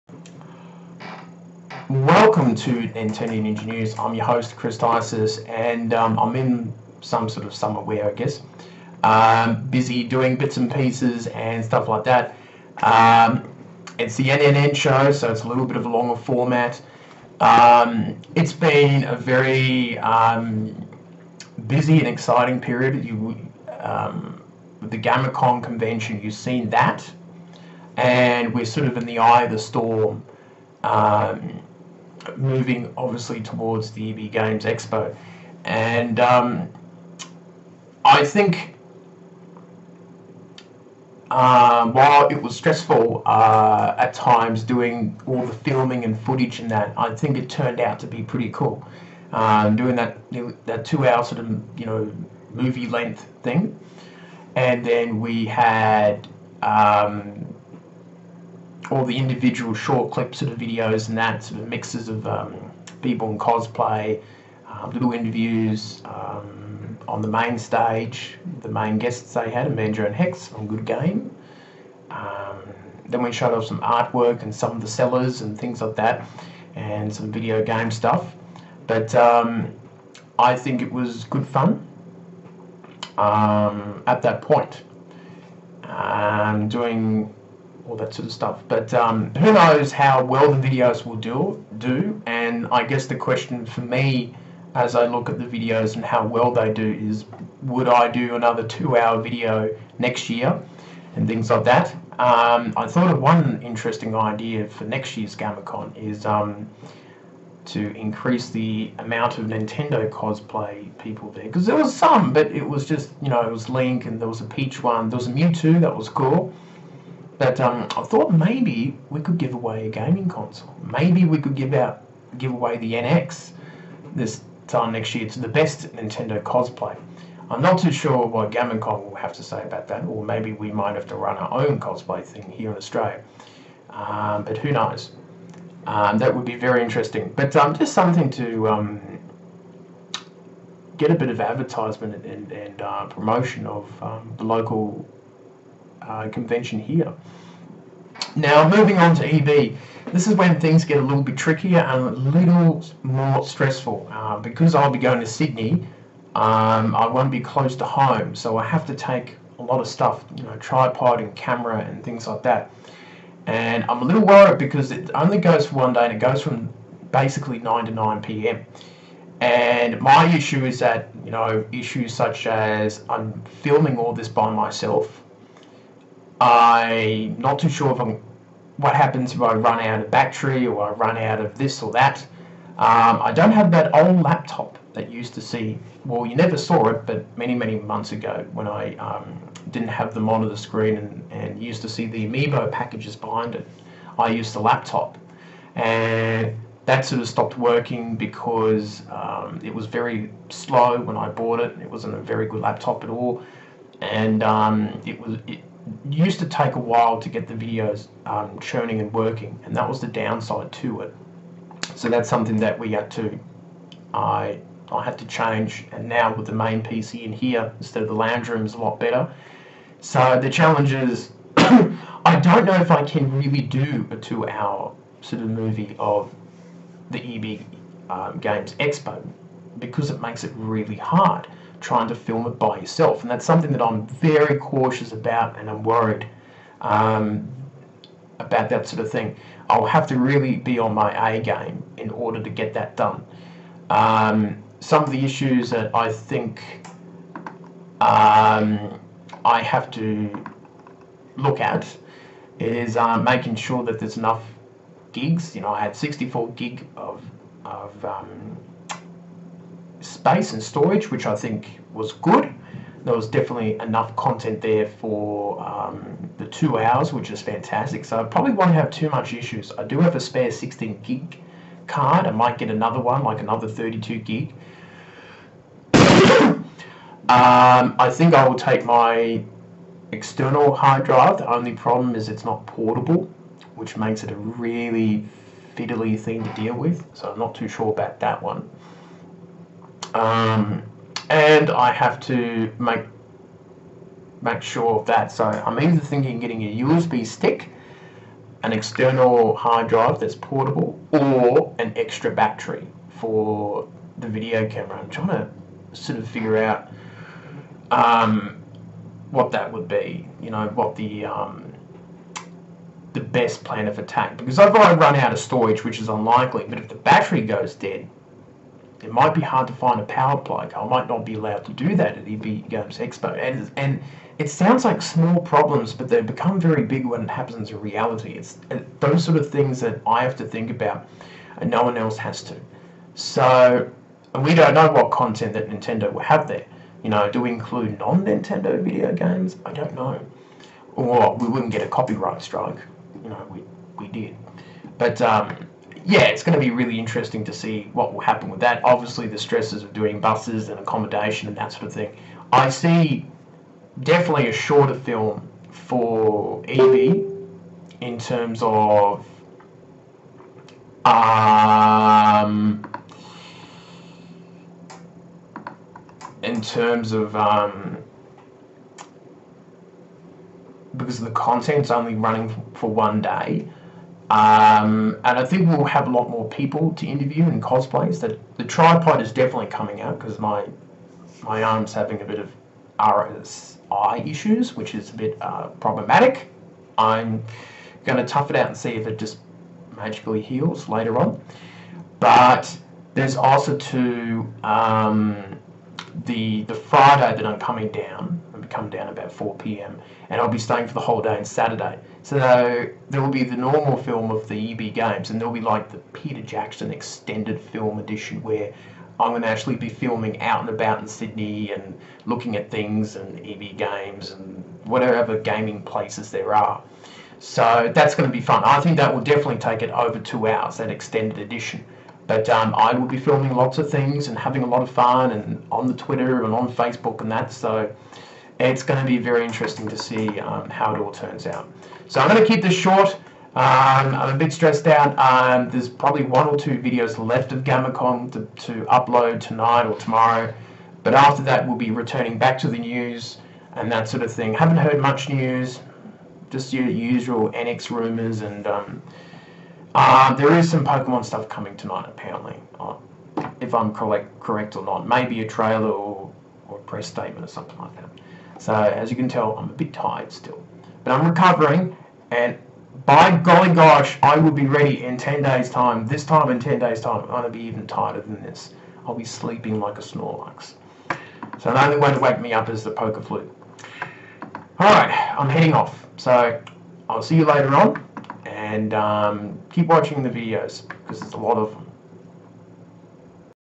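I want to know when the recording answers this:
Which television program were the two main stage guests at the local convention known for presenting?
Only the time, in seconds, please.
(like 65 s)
70 s.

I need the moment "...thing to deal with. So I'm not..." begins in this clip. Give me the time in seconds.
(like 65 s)
286 s.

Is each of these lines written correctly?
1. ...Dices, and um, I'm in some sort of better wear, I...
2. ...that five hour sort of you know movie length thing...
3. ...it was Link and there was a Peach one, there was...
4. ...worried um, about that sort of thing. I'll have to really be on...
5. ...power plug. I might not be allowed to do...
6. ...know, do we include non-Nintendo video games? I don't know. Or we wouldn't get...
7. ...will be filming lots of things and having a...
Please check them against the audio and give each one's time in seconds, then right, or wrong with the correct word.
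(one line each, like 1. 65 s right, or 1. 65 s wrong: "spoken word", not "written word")
1. 4 s wrong: "summer", not "better"
2. 50 s wrong: "two", not "five"
3. 113 s right
4. 235 s right
5. 320 s right
6. 337 s right
7. 422 s right.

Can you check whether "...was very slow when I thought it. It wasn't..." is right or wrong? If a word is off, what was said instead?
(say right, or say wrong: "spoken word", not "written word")
wrong: "bought", not "thought".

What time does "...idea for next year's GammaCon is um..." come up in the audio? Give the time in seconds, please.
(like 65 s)
104 s.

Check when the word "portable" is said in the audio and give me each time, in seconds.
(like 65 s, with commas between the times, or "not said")
282 s, 300 s.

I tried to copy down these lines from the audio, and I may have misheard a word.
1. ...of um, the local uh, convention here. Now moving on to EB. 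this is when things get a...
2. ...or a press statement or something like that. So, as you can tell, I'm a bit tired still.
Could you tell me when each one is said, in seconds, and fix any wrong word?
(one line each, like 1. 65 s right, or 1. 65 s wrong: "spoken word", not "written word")
1. 143 s right
2. 456 s right.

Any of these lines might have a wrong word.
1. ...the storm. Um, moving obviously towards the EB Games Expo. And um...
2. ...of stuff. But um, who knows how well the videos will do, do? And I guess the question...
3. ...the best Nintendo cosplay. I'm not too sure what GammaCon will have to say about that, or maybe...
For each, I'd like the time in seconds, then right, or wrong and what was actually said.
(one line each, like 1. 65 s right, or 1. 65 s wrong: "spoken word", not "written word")
1. 29 s right
2. 88 s right
3. 125 s right.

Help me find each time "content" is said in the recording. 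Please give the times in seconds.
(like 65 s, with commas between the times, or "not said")
264 s, 335 s, 371 s.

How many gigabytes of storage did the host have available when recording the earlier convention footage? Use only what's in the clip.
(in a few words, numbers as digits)
64.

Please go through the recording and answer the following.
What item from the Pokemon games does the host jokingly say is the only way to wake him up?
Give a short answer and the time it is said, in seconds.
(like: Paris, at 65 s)
Poké Flute, at 472 s.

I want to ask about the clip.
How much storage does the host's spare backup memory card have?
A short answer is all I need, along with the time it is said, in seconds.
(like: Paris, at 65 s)
16 gig, at 270 s.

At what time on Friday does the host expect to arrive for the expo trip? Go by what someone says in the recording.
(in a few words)
4 p.m.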